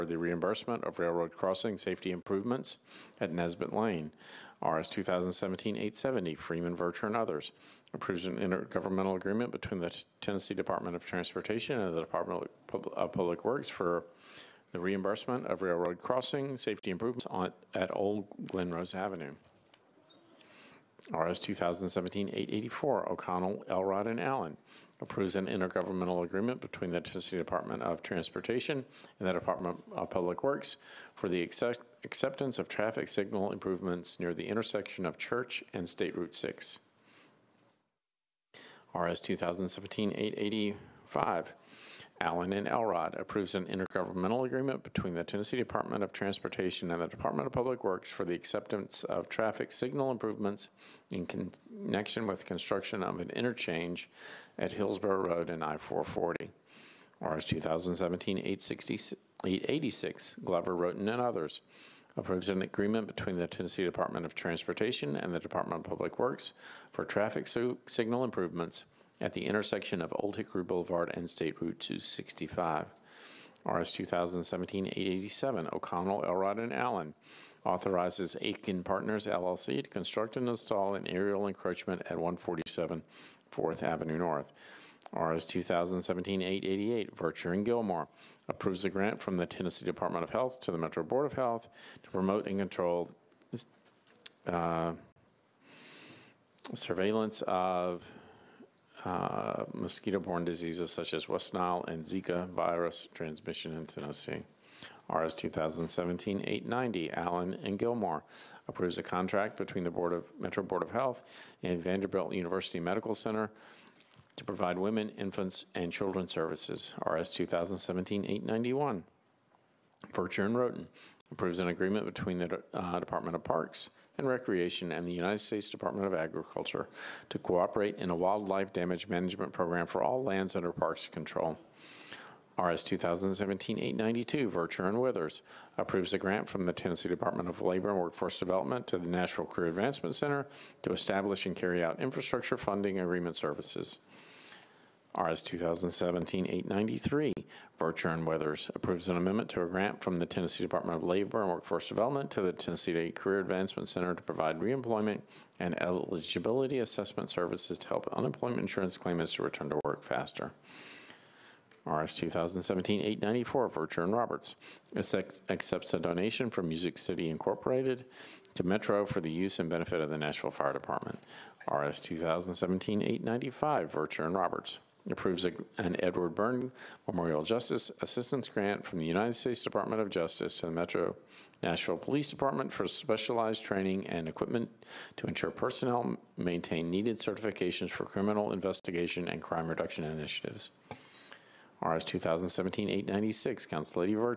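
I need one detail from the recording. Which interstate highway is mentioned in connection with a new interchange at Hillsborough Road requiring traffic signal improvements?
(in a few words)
I-440.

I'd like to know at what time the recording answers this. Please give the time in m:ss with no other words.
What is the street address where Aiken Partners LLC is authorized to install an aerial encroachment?
1:22.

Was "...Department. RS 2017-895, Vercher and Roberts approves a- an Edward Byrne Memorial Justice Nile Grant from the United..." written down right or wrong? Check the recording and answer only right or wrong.
wrong.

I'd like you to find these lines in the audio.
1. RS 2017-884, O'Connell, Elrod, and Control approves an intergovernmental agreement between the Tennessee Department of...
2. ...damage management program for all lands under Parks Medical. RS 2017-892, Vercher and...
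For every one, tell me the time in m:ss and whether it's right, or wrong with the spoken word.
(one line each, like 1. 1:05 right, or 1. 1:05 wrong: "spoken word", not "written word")
1. 0:21 wrong: "Allen", not "Control"
2. 2:08 wrong: "Control", not "Medical".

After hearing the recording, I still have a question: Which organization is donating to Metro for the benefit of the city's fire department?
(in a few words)
Music City Incorporated.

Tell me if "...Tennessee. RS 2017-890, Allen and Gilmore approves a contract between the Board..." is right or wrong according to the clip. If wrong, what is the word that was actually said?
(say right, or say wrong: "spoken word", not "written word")
right.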